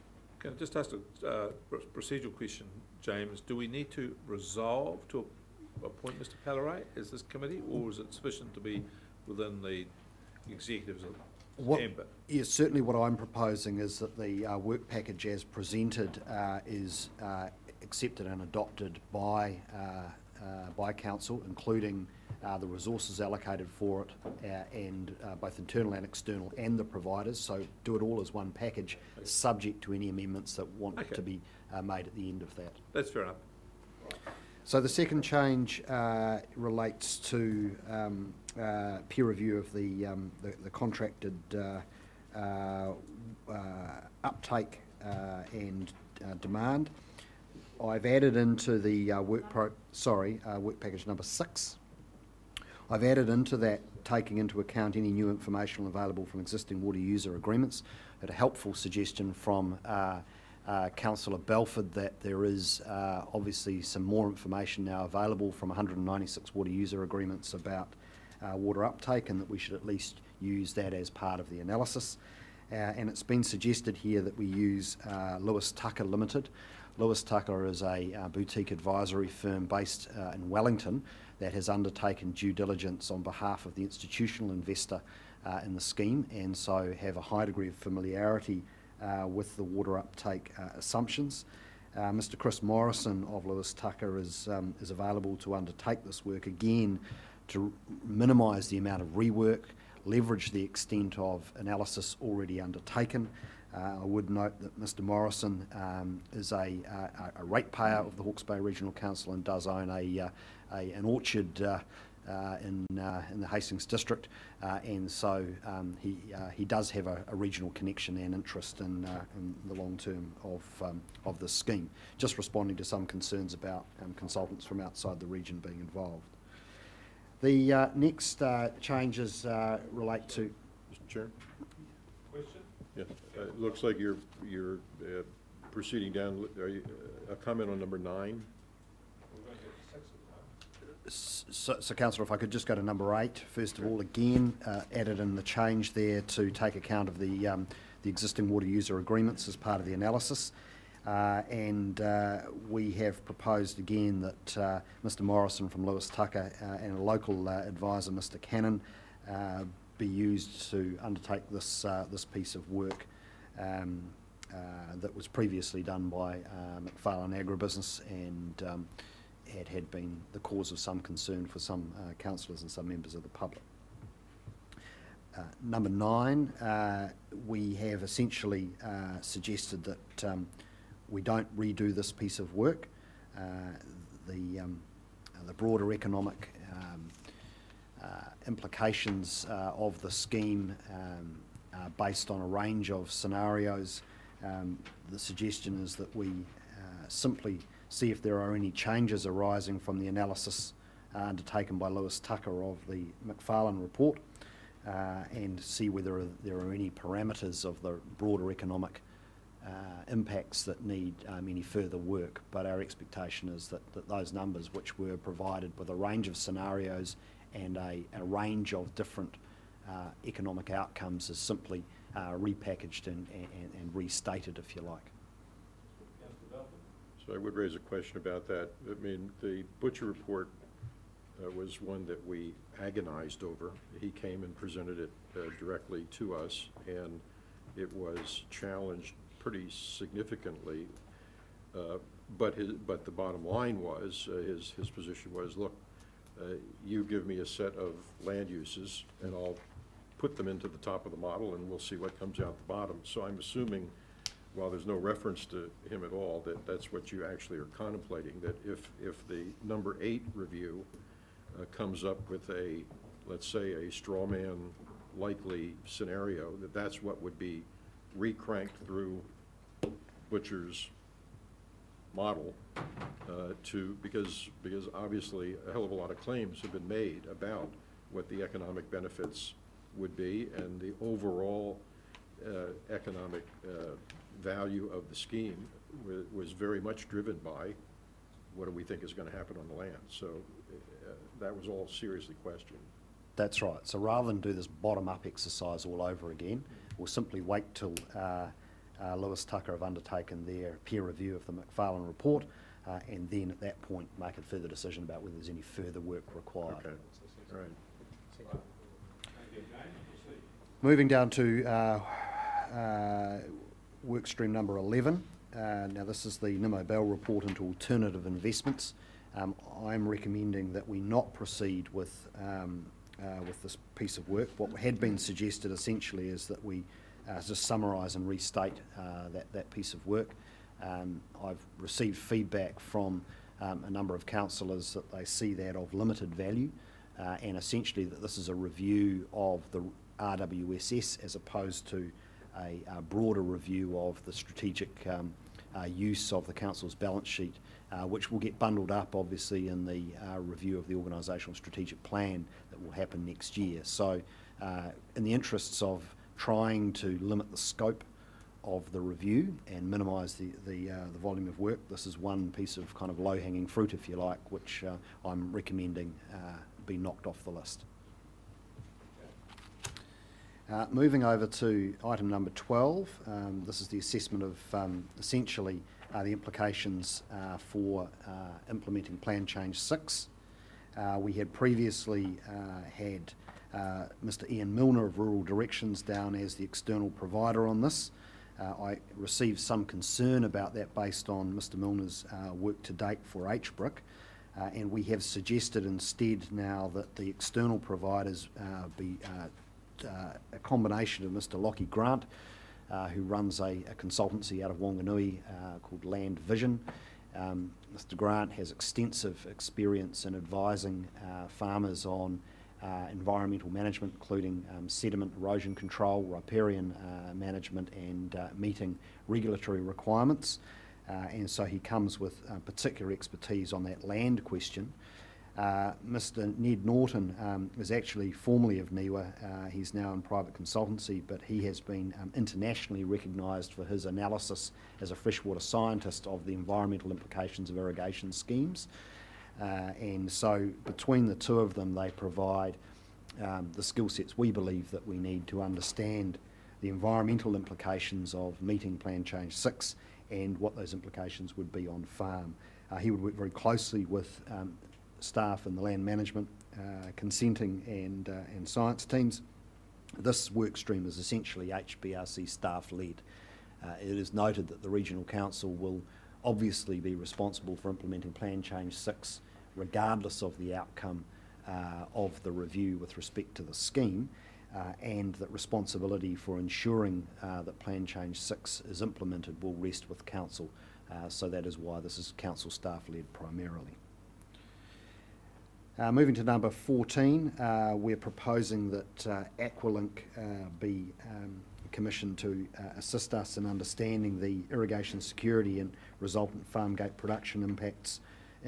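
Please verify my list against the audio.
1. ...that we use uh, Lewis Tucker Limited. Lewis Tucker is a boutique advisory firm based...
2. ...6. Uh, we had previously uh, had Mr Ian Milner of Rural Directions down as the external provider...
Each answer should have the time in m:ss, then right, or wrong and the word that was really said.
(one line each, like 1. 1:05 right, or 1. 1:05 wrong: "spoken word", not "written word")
1. 1:14 right
2. 6:19 right.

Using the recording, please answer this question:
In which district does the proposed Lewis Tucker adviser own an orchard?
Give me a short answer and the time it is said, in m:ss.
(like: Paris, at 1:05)
Hastings, at 1:53.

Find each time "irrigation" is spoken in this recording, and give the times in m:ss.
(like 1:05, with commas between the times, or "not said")
7:17, 8:14.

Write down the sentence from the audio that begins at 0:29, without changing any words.
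subject to any amendments that want okay.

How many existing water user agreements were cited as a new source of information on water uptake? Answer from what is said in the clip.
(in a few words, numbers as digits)
196.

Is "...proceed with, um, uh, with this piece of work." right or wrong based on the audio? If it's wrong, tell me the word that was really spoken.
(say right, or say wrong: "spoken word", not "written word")
right.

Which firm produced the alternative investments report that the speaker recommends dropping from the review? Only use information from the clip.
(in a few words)
Nimmo Bell.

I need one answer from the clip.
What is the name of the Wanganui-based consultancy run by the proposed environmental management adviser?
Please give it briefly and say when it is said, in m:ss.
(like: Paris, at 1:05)
Land Vision, at 6:46.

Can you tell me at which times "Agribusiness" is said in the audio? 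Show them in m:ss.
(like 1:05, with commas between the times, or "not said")
2:47.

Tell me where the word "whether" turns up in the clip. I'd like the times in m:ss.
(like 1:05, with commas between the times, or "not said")
3:25, 5:05.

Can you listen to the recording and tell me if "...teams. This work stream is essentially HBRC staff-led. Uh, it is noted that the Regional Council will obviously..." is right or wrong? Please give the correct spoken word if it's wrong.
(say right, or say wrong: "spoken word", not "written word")
right.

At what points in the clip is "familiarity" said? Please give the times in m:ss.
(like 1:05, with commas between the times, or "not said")
1:27.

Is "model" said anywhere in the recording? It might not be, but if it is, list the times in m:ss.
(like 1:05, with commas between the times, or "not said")
4:11, 4:32.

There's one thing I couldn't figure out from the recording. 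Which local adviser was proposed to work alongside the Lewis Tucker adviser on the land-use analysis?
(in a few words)
Mr Cannon.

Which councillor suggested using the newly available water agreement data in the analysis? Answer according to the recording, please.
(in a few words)
Councillor Belford.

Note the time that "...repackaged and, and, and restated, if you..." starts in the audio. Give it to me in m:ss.
3:42.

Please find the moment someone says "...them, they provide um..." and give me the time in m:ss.
7:21.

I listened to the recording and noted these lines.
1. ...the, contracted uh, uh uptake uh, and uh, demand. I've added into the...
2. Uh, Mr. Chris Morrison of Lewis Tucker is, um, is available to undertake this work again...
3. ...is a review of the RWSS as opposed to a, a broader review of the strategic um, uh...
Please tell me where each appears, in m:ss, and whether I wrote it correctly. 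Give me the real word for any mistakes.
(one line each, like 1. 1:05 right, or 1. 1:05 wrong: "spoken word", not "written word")
1. 0:40 right
2. 1:31 right
3. 5:38 right.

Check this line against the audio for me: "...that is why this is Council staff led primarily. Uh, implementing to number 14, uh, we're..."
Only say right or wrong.
wrong.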